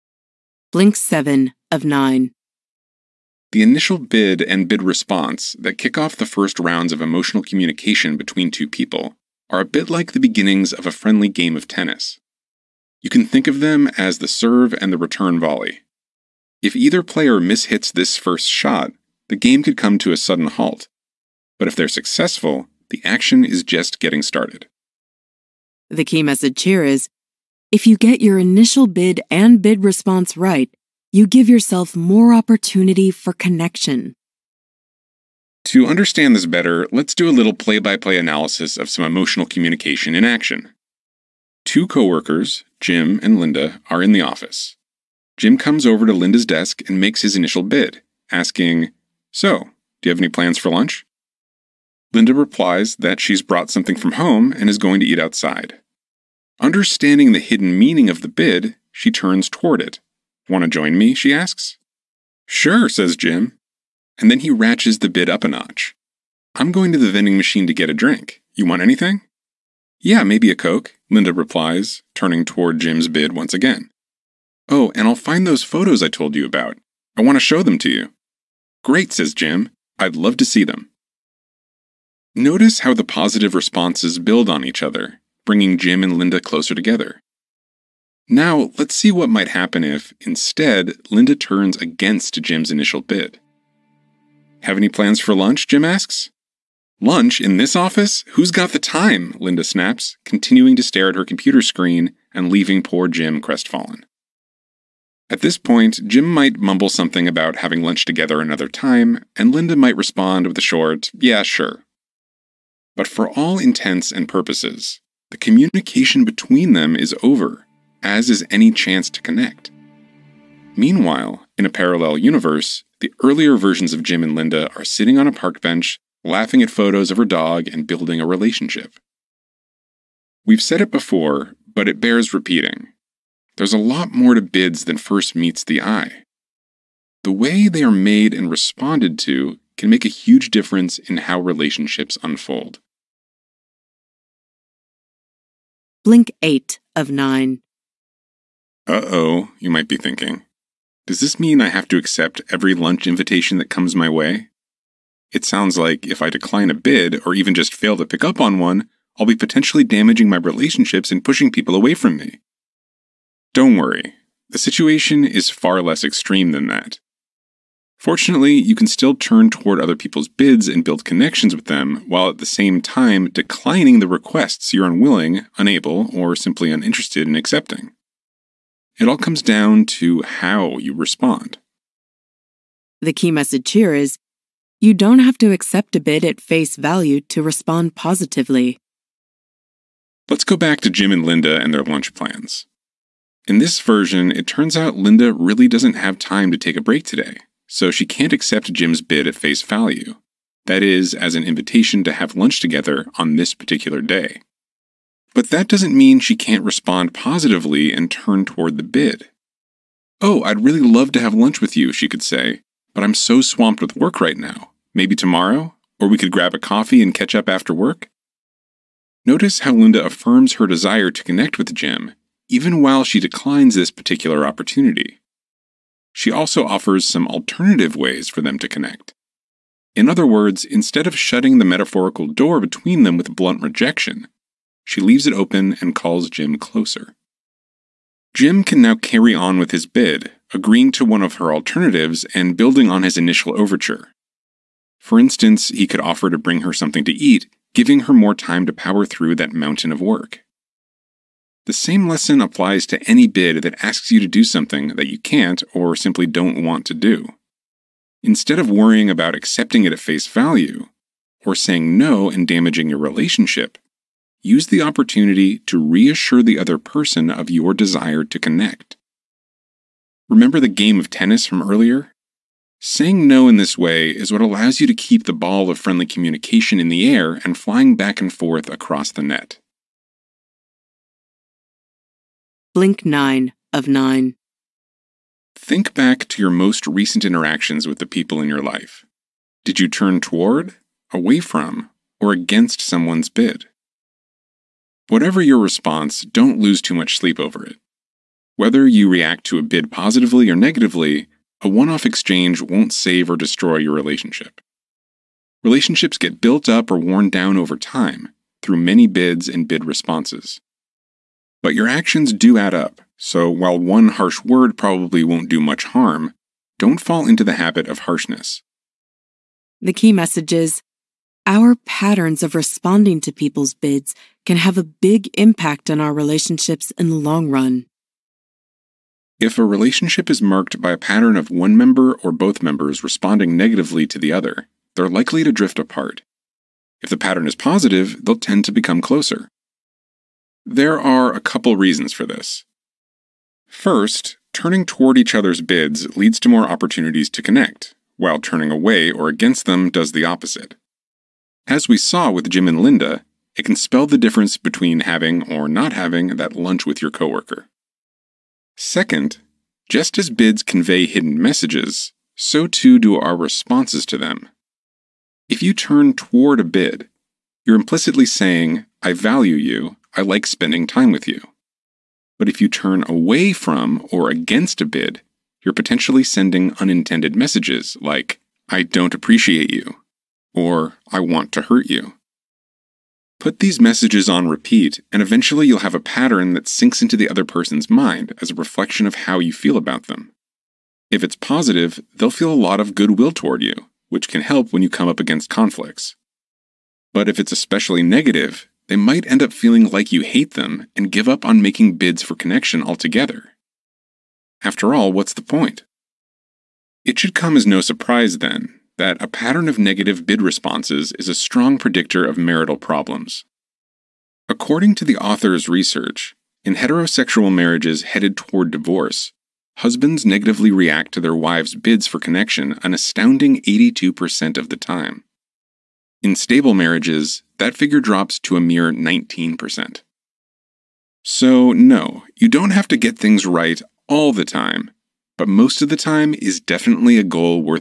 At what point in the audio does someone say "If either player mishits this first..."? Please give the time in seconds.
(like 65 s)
16 s.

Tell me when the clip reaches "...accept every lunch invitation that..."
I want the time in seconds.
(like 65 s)
151 s.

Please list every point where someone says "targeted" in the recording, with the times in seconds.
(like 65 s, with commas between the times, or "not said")
not said.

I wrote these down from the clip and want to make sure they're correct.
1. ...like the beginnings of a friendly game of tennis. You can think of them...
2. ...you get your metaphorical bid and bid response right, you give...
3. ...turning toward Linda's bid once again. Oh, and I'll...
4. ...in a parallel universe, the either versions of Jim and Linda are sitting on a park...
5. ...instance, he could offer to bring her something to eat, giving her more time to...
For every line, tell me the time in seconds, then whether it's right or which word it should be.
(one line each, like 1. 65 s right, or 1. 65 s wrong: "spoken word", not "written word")
1. 9 s right
2. 27 s wrong: "initial", not "metaphorical"
3. 72 s wrong: "Jim", not "Linda"
4. 121 s wrong: "earlier", not "either"
5. 245 s right.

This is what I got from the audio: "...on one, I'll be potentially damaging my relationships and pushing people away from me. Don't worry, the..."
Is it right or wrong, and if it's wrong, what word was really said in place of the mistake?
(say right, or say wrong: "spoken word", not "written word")
right.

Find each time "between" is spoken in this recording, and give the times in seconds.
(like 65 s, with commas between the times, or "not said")
8 s, 116 s, 232 s, 354 s.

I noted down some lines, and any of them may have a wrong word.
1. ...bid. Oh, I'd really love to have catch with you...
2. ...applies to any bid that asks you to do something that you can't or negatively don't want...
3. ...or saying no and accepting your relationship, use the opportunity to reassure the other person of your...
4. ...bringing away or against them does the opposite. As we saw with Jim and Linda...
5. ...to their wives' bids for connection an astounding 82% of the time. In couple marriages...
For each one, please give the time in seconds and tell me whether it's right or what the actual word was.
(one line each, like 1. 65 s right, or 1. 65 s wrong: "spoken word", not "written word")
1. 208 s wrong: "lunch", not "catch"
2. 252 s wrong: "simply", not "negatively"
3. 261 s wrong: "damaging", not "accepting"
4. 348 s wrong: "turning", not "bringing"
5. 421 s wrong: "stable", not "couple".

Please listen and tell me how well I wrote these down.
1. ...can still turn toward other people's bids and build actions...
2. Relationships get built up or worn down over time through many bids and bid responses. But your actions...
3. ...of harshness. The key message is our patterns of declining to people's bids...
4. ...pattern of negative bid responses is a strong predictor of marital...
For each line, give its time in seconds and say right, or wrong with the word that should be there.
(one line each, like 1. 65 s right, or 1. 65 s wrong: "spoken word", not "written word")
1. 168 s wrong: "connections", not "actions"
2. 305 s right
3. 317 s wrong: "responding", not "declining"
4. 409 s right.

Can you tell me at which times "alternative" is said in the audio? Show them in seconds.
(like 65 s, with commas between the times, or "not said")
227 s, 241 s.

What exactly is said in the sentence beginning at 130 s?
We've said it before, but it bears repeating.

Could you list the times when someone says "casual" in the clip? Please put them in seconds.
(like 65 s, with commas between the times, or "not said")
not said.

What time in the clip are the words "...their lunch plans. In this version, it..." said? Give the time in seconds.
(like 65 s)
191 s.